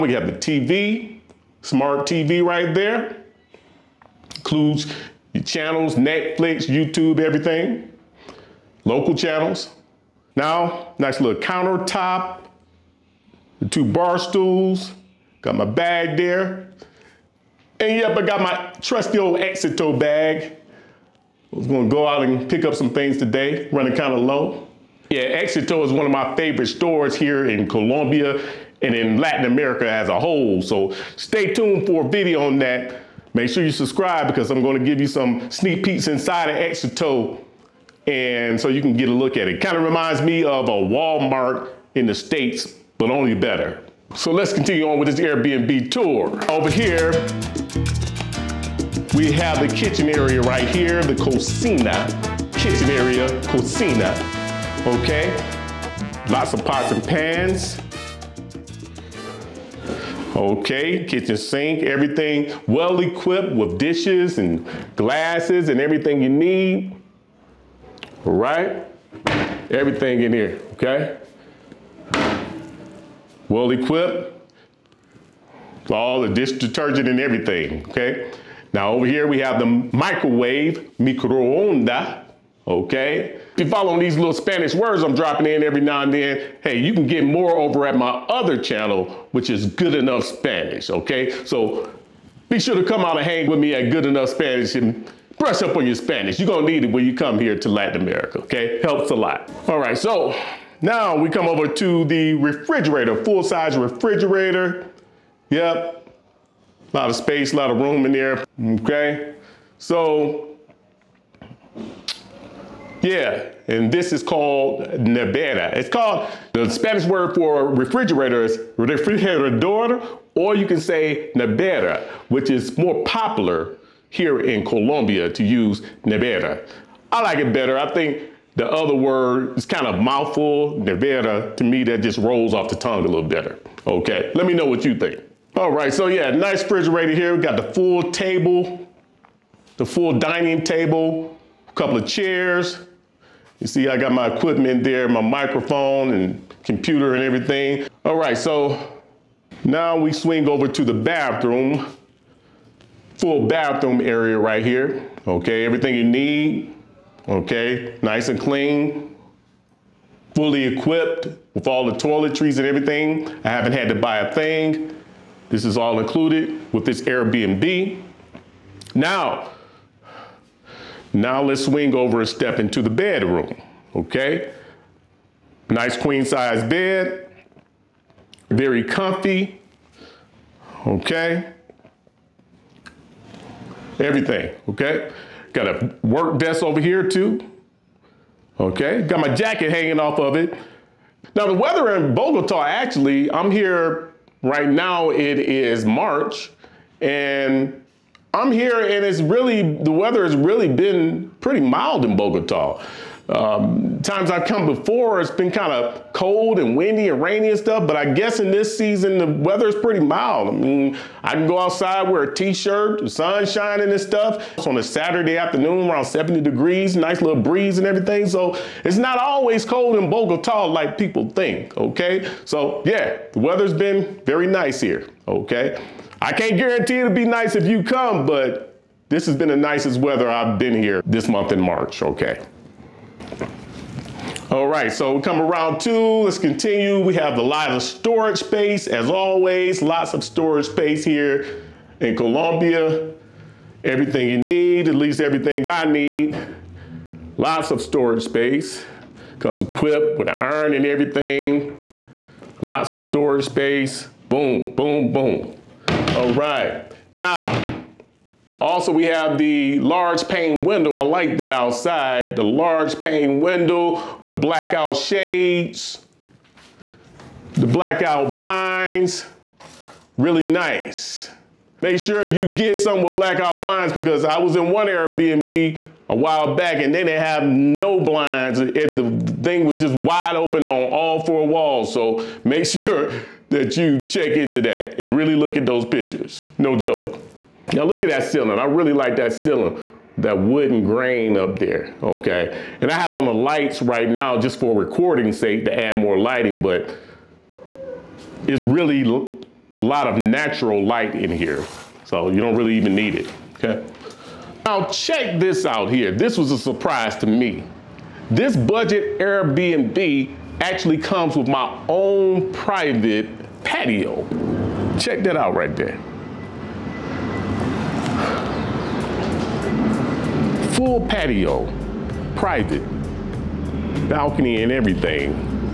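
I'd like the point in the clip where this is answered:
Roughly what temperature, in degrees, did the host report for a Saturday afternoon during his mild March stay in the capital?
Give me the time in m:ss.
3:35.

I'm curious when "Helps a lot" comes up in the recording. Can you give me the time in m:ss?
1:38.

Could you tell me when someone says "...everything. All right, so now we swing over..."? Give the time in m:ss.
2:27.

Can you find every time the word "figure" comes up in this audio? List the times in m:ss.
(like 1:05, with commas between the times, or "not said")
not said.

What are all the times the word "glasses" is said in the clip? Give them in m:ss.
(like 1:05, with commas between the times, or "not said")
1:04.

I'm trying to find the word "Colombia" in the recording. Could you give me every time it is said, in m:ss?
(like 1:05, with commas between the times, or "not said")
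0:27, 2:04, 4:02.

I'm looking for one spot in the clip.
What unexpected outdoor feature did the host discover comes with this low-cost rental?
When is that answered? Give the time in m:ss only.
5:11.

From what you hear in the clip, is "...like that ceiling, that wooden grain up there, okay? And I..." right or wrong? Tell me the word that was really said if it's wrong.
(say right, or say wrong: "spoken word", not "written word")
right.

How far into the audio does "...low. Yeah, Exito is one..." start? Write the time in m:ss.
0:24.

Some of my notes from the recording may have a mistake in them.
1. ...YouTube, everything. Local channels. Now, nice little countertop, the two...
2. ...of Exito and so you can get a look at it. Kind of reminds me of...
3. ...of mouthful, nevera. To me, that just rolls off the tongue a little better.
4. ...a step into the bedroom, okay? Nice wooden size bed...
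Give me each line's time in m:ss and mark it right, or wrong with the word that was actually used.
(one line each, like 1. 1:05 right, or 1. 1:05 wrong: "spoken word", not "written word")
1. 0:06 right
2. 0:36 right
3. 2:09 right
4. 2:52 wrong: "queen", not "wooden".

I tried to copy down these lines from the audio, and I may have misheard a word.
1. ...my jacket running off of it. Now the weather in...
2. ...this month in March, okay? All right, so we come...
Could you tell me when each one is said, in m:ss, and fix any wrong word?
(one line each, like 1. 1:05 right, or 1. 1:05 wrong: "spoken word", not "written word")
1. 3:09 wrong: "hanging", not "running"
2. 3:51 right.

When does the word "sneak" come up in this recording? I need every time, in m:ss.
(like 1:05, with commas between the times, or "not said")
0:35.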